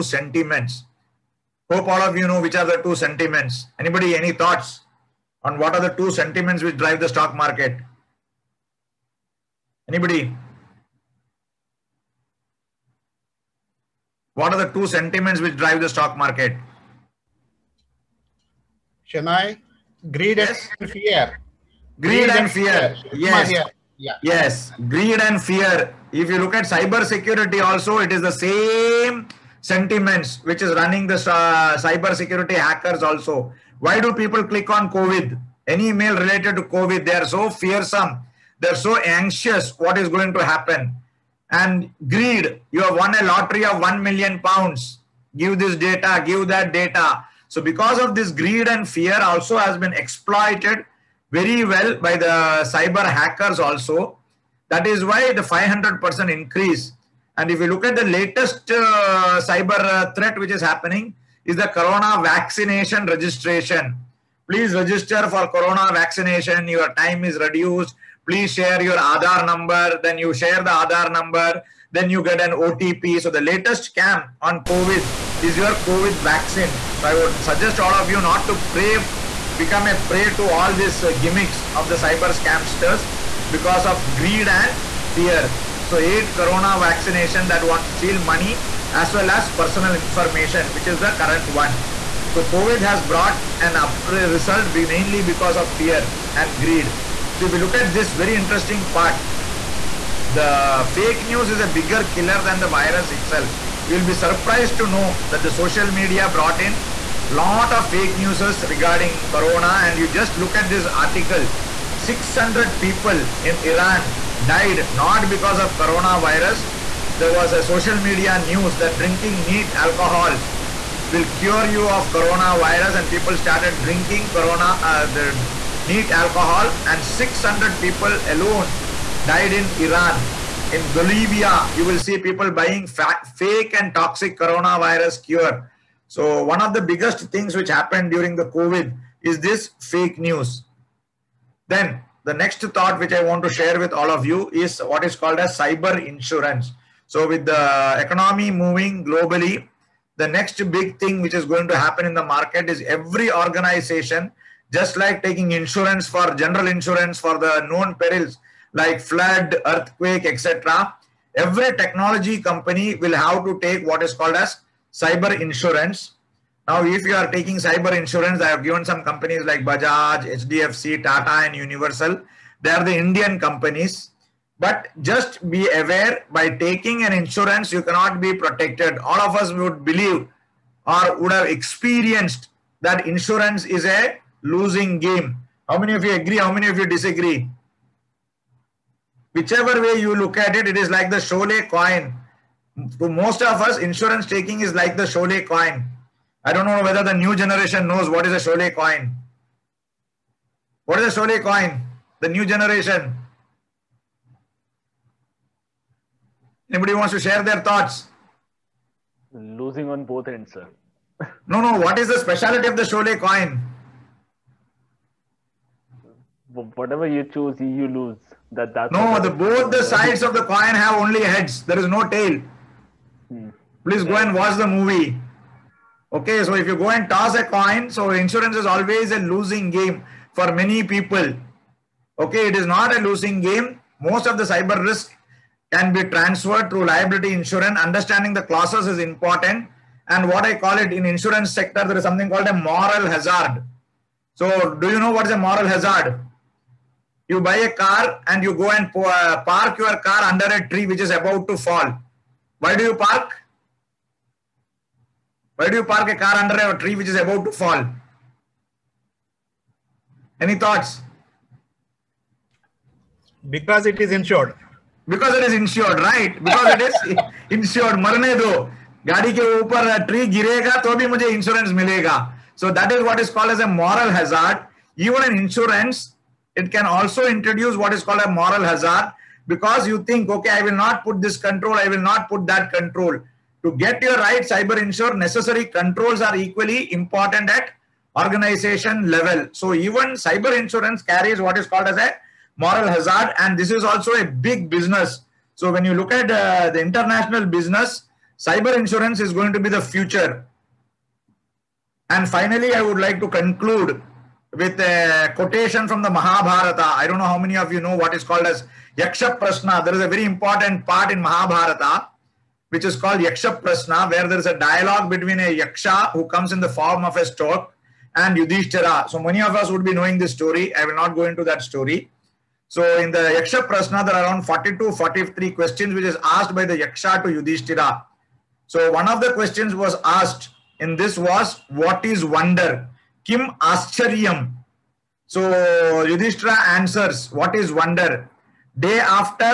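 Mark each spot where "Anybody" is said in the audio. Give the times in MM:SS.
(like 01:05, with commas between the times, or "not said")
00:03, 00:09, 03:26.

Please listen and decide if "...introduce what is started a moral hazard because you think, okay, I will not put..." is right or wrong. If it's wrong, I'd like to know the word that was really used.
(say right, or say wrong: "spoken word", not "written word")
wrong: "called", not "started".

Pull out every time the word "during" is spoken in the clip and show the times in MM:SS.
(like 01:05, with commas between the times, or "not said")
02:18.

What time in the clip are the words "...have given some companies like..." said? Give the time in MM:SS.
02:48.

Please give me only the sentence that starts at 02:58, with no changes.
All of us would believe or would have experienced that insurance is a losing game.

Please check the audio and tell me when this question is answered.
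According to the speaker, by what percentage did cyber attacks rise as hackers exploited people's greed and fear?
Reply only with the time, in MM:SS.
00:55.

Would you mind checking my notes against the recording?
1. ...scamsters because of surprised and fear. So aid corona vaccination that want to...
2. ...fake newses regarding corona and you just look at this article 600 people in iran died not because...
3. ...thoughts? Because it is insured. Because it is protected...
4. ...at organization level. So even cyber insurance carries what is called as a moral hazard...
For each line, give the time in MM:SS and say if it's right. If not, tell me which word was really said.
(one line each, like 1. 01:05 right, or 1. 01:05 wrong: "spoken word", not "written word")
1. 01:22 wrong: "greed", not "surprised"
2. 01:47 right
3. 04:20 wrong: "insured", not "protected"
4. 04:47 right.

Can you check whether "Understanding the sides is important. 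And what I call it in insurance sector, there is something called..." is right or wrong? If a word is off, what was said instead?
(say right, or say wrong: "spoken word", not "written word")
wrong: "clauses", not "sides".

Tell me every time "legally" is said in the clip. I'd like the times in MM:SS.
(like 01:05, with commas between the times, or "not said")
not said.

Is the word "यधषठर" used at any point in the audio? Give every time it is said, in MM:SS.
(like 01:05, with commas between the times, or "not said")
05:36.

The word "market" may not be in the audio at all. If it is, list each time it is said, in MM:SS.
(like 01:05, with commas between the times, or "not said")
00:07, 00:16, 02:32.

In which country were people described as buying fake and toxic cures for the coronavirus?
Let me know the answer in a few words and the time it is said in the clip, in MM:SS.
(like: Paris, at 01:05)
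Bolivia, at 02:10.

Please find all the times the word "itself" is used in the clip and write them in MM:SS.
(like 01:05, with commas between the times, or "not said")
01:43.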